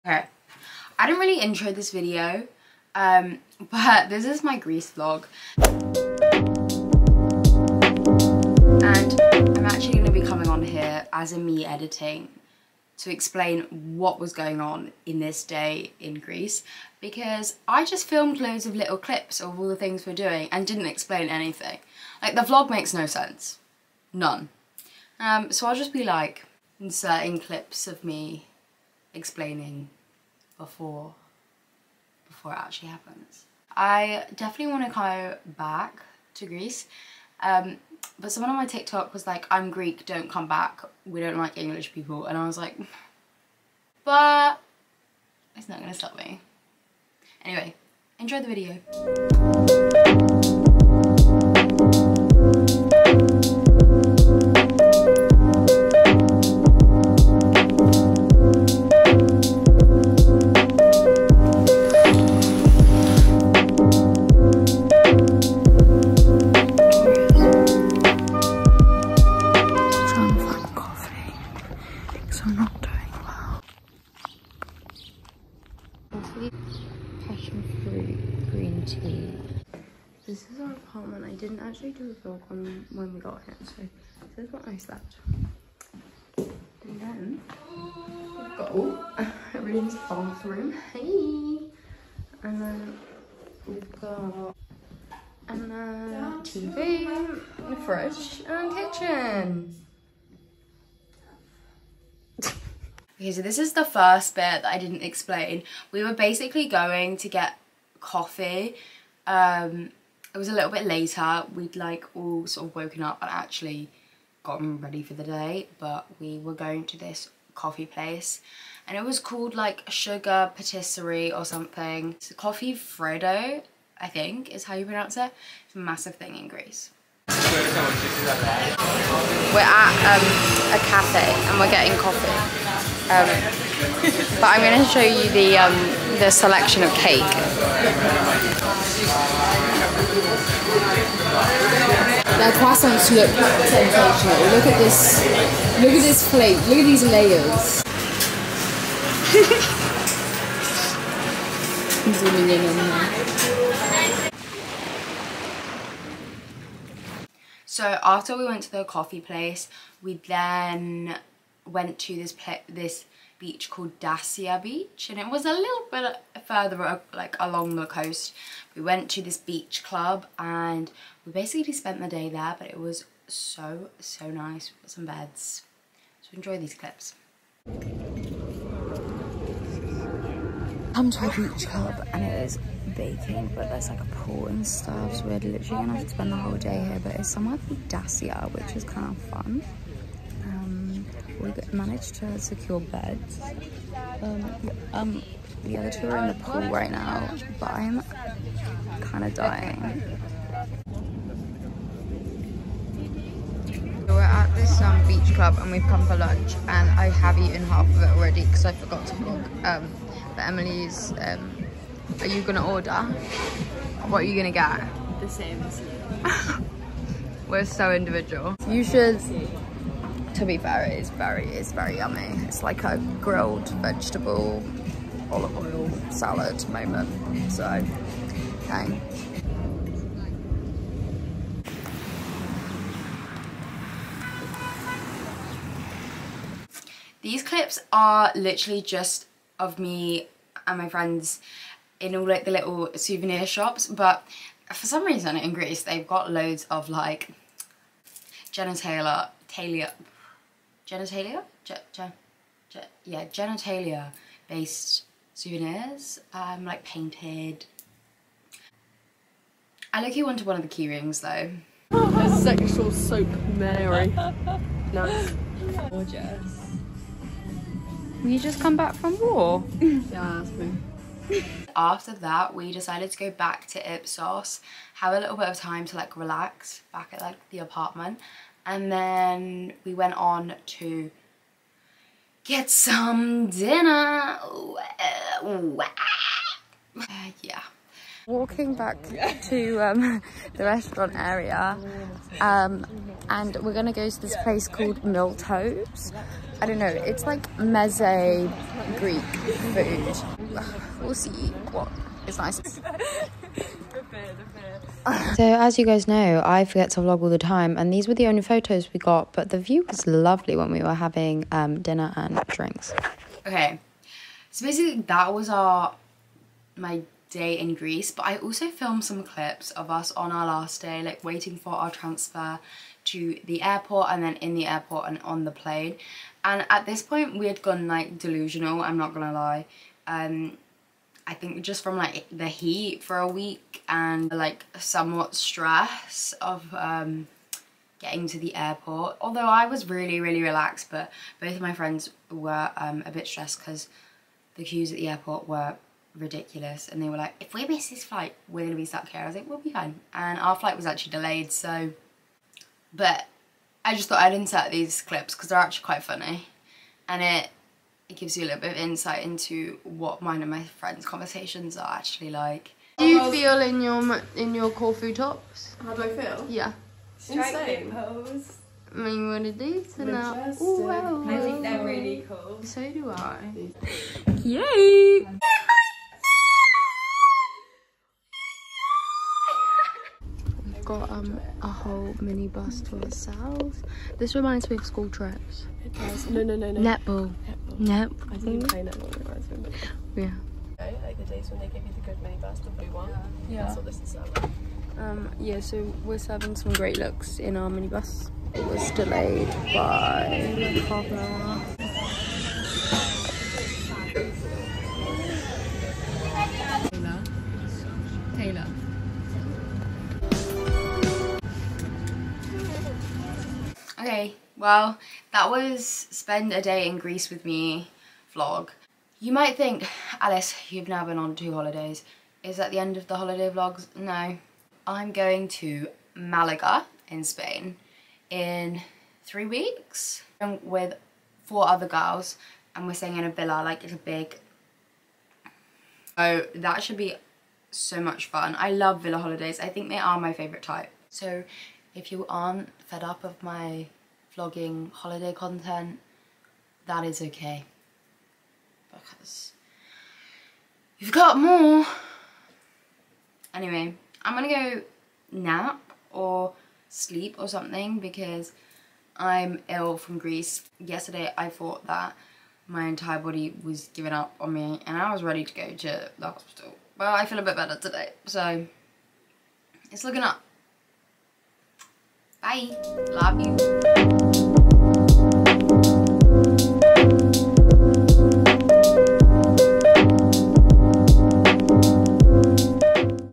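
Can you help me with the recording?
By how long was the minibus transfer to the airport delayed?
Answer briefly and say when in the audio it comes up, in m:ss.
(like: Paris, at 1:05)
Half an hour, at 6:40.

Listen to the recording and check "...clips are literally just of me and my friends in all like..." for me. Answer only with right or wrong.
right.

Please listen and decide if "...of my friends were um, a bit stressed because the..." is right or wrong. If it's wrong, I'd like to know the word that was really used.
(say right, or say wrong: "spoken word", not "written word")
right.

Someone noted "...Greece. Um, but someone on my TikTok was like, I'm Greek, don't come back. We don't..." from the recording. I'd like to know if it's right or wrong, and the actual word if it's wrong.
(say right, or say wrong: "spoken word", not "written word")
right.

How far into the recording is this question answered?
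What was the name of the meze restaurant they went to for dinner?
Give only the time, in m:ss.
4:55.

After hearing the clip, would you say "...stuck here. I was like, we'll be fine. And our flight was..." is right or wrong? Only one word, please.
right.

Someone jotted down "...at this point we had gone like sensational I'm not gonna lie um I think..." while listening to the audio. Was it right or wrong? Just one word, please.
wrong.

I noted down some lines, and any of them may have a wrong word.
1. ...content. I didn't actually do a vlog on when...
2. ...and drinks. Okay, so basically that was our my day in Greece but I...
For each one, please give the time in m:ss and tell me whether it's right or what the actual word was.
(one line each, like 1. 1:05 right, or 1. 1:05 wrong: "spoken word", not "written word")
1. 1:20 wrong: "apartment", not "content"
2. 5:12 right.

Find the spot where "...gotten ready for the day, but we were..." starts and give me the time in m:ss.
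1:54.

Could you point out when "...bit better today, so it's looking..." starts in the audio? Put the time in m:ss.
7:47.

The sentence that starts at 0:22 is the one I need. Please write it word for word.
Like the vlog makes no sense.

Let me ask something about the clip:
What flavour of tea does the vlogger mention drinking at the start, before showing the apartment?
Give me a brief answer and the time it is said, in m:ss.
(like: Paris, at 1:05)
Passion fruit green tea, at 1:17.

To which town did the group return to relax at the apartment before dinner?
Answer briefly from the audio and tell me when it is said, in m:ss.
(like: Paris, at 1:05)
Ipsos, at 4:33.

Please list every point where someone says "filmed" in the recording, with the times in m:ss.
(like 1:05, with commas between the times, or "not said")
0:18, 5:18.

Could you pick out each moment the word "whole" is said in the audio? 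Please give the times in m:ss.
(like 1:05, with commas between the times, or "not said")
3:06, 6:21.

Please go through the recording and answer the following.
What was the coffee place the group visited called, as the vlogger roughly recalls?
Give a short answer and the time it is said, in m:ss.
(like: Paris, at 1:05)
Sugar Patisserie, at 1:59.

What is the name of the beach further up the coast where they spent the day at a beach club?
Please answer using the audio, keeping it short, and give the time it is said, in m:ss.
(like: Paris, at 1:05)
Dassia Beach, at 2:44.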